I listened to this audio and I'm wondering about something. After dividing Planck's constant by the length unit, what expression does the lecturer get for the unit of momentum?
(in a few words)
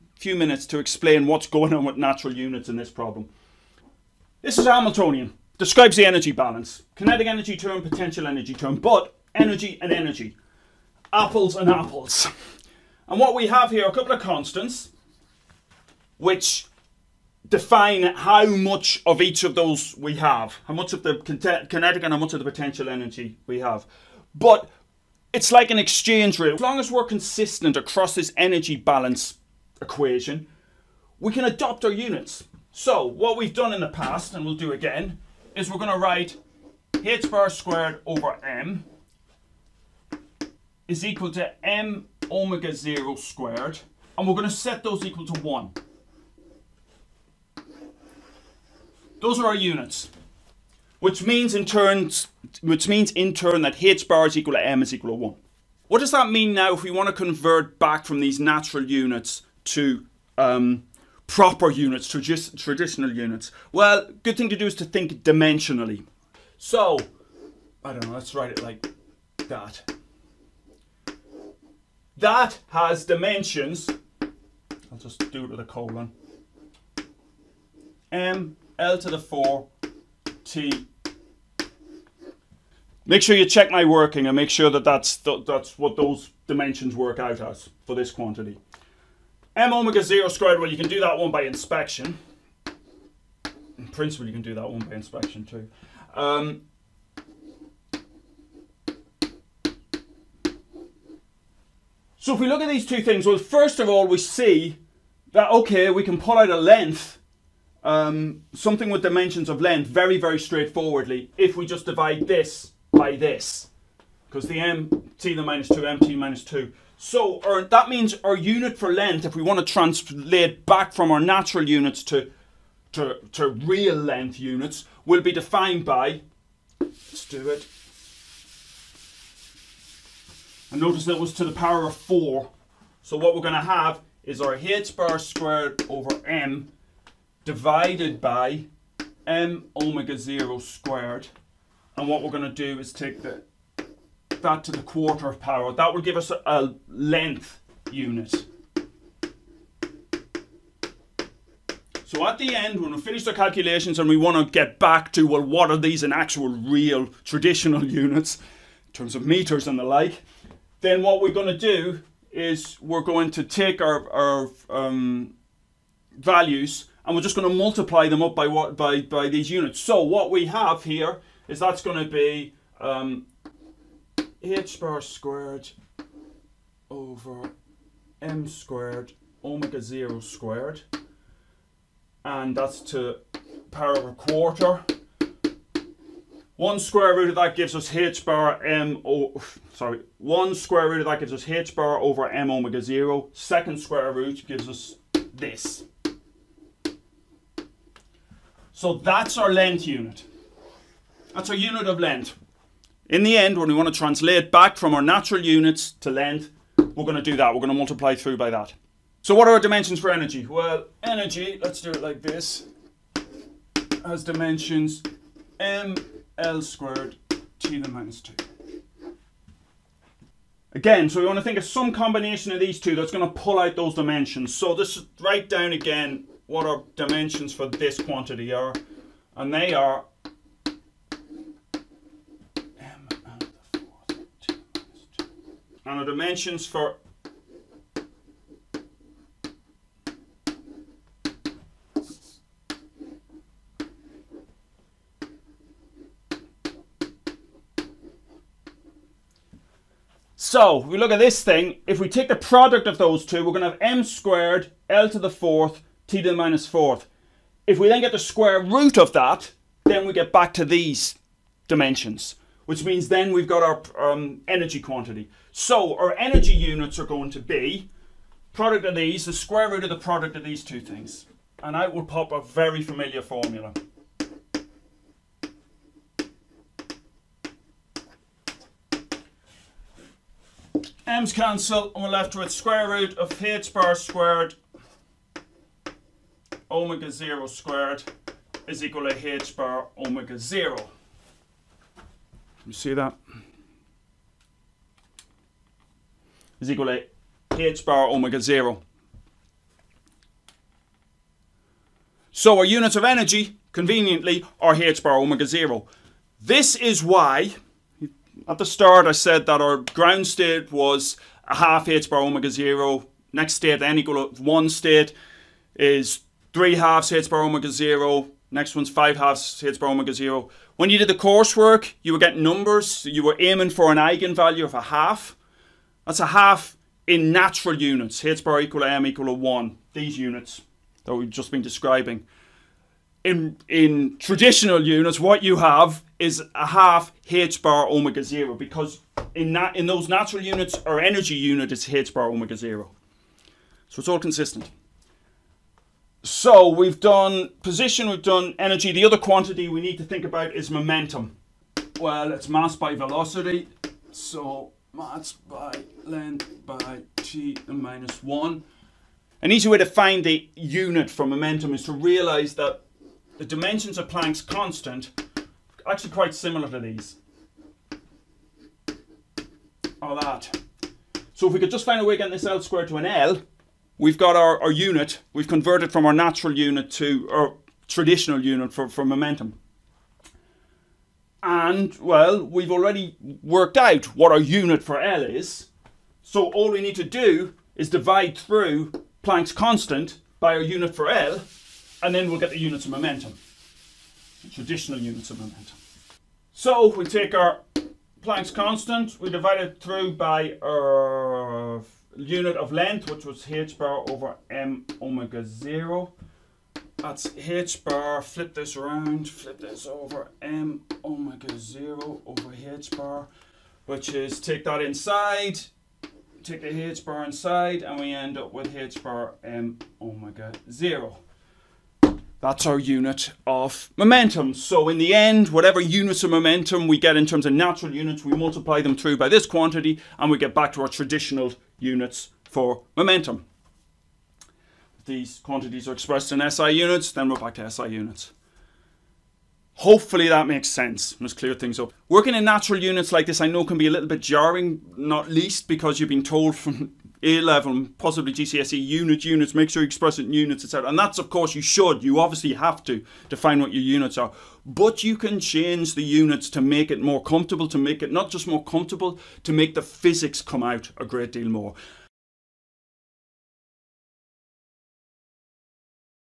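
square root of h bar m omega 0.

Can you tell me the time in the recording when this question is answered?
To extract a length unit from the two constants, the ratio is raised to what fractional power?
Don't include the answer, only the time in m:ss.
2:24.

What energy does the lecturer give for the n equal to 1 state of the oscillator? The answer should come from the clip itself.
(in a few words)
3/2 h bar omega 0.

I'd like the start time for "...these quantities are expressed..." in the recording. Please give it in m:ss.
7:15.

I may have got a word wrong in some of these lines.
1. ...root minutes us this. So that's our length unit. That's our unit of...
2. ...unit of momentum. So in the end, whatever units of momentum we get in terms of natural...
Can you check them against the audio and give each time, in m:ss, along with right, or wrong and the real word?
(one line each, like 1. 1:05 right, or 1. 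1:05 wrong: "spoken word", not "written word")
1. 3:14 wrong: "gives", not "minutes"
2. 7:02 right.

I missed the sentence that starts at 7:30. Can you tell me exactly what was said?
And that's, of course, you should.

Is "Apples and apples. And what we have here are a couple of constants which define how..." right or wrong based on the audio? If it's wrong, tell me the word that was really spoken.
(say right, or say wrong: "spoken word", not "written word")
right.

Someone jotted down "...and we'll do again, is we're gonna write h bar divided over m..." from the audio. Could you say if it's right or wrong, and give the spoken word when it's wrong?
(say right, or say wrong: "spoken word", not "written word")
wrong: "squared", not "divided".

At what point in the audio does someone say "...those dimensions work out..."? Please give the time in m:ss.
1:25.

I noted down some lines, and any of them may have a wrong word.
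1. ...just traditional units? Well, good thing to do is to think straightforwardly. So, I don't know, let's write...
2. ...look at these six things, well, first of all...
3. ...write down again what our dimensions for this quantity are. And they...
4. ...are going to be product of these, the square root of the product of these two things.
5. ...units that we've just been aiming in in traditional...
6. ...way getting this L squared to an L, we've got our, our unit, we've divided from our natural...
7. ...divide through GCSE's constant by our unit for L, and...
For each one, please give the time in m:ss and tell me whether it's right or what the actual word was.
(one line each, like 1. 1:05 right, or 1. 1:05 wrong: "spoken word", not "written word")
1. 1:02 wrong: "dimensionally", not "straightforwardly"
2. 1:42 wrong: "two", not "six"
3. 3:45 right
4. 4:26 right
5. 5:30 wrong: "describing", not "aiming"
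6. 6:12 wrong: "converted", not "divided"
7. 6:27 wrong: "Planck", not "GCSE".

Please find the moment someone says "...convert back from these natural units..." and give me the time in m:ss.
0:57.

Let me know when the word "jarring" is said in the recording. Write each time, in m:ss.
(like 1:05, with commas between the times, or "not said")
7:24.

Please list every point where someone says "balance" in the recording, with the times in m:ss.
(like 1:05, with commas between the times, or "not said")
0:06, 0:28.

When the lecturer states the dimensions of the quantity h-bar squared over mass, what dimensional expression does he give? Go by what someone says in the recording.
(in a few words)
M L^4 T.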